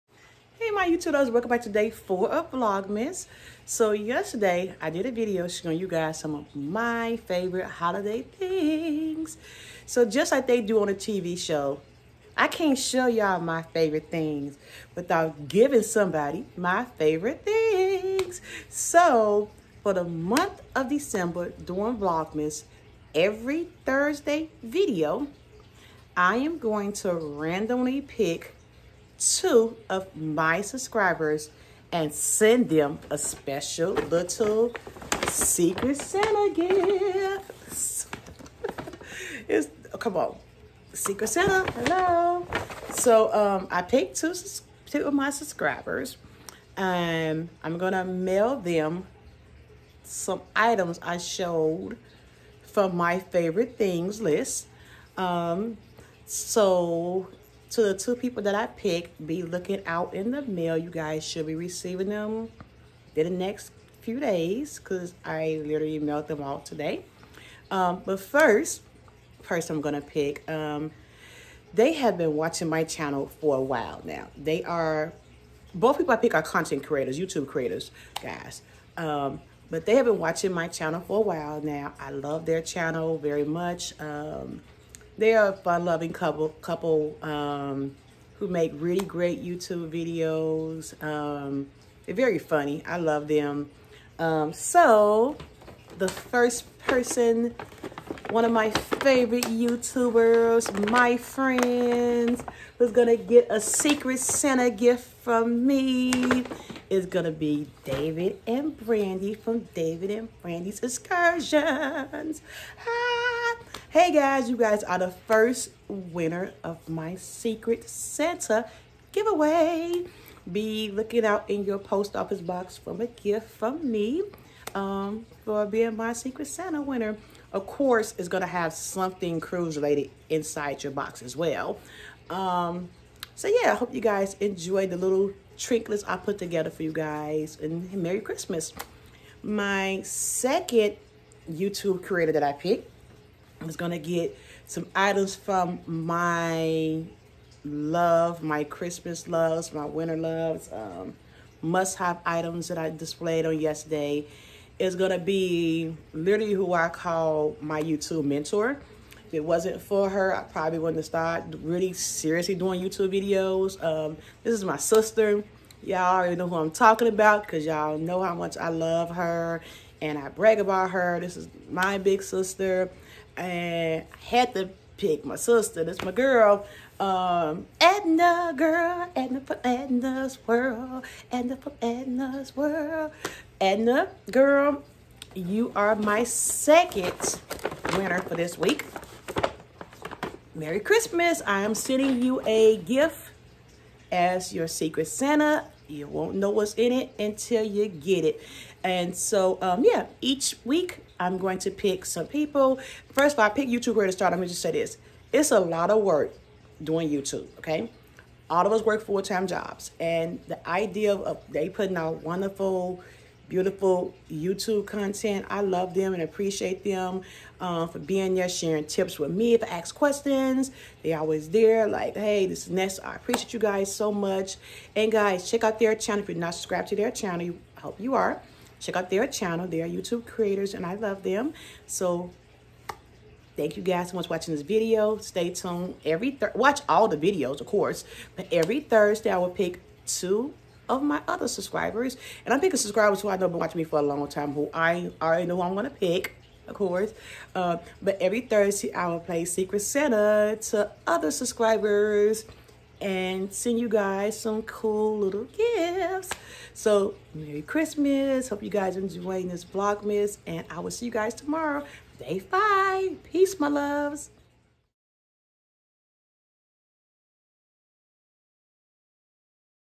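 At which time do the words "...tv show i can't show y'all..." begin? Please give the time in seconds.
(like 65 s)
10 s.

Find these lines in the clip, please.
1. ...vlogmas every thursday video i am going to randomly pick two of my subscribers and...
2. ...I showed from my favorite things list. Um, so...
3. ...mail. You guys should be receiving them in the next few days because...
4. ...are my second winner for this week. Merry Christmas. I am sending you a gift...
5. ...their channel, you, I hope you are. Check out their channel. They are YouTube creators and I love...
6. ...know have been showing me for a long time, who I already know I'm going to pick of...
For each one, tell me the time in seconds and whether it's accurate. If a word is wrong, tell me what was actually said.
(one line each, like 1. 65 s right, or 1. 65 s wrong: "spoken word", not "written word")
1. 21 s right
2. 51 s right
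3. 60 s right
4. 185 s right
5. 226 s right
6. 243 s wrong: "watching", not "showing".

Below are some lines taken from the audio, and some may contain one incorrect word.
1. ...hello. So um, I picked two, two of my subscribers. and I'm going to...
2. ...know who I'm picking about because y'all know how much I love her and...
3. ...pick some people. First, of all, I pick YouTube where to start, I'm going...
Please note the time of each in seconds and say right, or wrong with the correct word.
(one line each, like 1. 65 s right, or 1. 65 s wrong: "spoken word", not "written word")
1. 41 s right
2. 166 s wrong: "talking", not "picking"
3. 201 s right.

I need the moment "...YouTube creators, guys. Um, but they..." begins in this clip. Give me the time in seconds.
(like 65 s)
77 s.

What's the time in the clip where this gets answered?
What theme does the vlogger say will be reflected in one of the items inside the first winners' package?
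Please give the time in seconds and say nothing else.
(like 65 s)
129 s.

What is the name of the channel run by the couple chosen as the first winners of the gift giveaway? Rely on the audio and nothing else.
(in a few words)
David and Brandy's Excursions.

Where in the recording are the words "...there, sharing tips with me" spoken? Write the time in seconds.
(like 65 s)
218 s.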